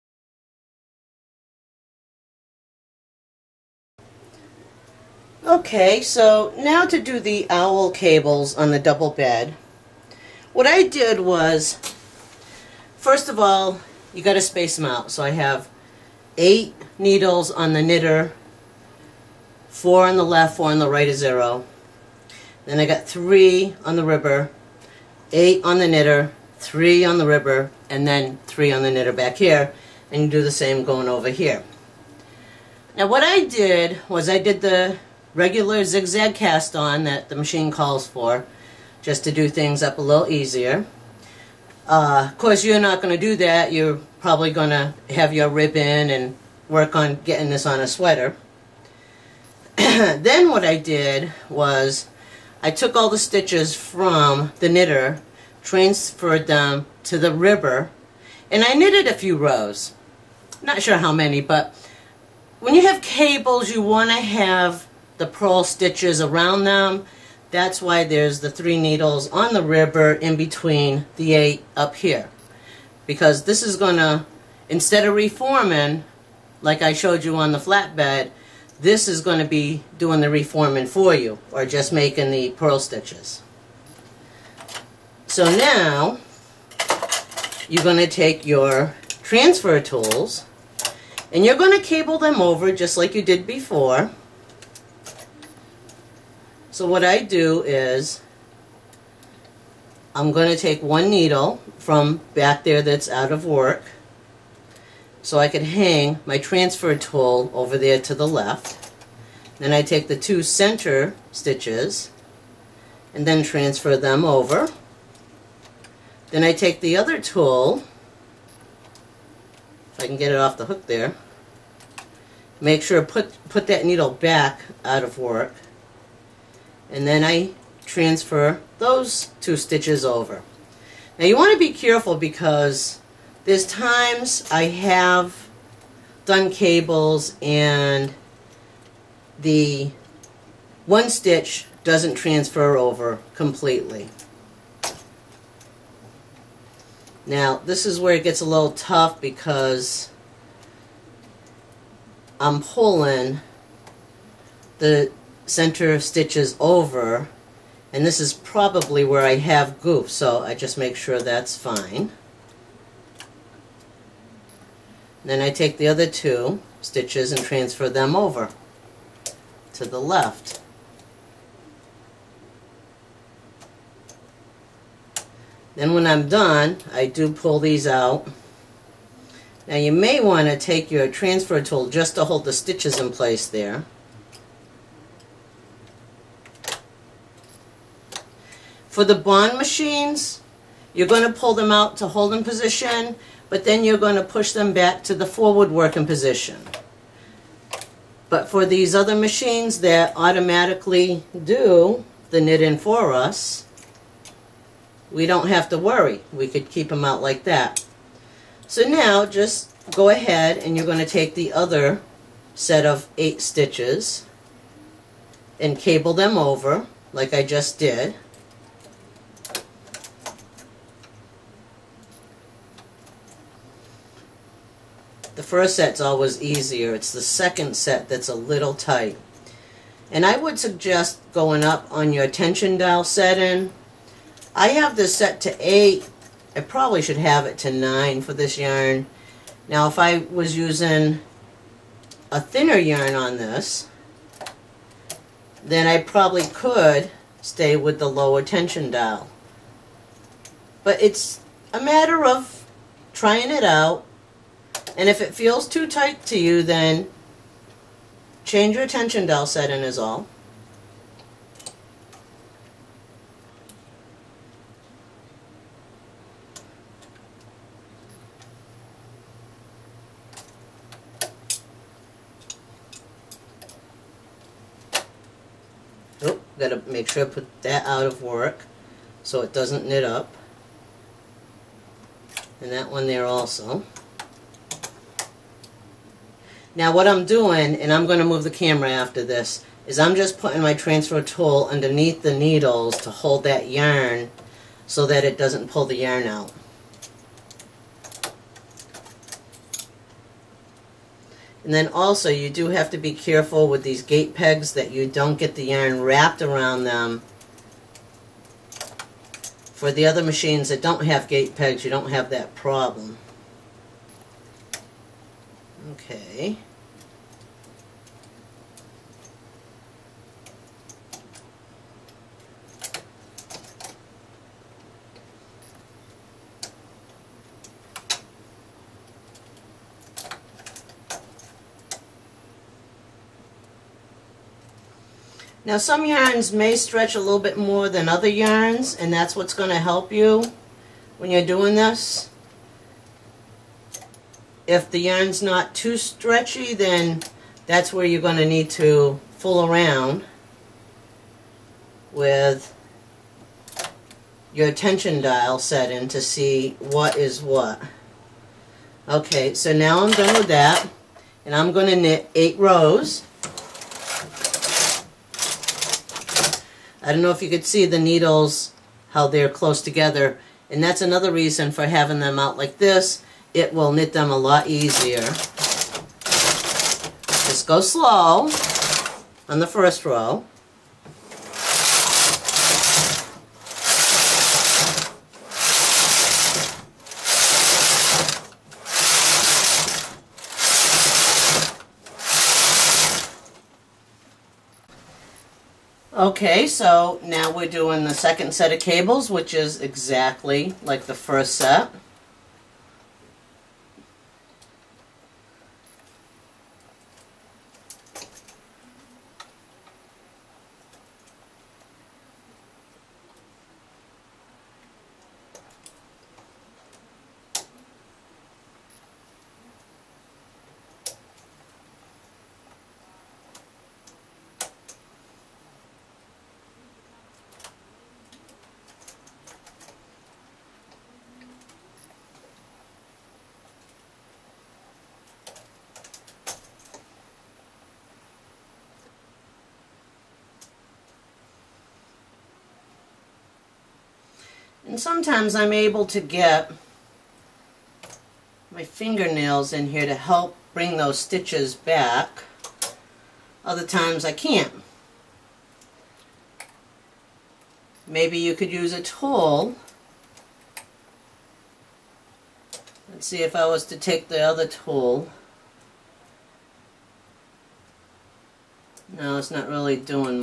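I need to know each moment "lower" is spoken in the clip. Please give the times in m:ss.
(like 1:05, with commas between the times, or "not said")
4:08.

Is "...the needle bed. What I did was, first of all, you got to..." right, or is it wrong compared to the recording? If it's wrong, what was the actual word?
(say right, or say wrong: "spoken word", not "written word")
wrong: "double", not "needle".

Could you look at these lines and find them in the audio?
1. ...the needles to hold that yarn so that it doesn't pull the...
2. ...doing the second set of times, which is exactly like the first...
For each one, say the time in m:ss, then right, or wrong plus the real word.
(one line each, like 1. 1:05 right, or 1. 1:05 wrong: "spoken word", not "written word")
1. 4:52 right
2. 6:37 wrong: "cables", not "times".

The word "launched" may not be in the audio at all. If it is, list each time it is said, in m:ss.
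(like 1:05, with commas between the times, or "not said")
not said.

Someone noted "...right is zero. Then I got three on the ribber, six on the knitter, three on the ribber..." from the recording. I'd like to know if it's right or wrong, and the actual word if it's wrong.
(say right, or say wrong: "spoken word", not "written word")
wrong: "eight", not "six".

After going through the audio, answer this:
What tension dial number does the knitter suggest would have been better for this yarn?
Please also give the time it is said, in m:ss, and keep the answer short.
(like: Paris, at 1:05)
9, at 3:57.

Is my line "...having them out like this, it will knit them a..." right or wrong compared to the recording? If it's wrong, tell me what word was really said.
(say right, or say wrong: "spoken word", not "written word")
right.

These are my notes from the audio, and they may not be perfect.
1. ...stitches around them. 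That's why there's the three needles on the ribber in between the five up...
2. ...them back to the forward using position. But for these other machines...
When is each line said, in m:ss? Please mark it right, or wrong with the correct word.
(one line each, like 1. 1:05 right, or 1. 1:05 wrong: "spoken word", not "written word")
1. 1:05 wrong: "eight", not "five"
2. 3:14 wrong: "working", not "using".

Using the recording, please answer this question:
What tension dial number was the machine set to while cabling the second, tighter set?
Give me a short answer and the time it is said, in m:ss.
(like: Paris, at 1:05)
8, at 3:55.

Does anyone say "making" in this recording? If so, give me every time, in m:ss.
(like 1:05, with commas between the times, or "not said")
1:21.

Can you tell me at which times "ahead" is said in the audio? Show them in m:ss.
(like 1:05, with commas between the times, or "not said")
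3:30.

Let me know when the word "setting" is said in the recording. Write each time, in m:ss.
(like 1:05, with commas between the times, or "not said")
3:53, 4:19.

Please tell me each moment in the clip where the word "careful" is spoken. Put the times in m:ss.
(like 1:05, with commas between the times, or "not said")
2:11, 5:03.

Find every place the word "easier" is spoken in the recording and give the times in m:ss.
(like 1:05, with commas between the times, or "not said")
0:40, 3:46, 6:14.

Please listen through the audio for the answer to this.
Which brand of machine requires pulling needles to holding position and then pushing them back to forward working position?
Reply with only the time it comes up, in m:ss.
3:09.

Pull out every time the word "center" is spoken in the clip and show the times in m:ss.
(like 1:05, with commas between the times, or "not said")
1:50, 2:35.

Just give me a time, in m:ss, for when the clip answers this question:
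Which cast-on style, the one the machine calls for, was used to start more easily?
0:35.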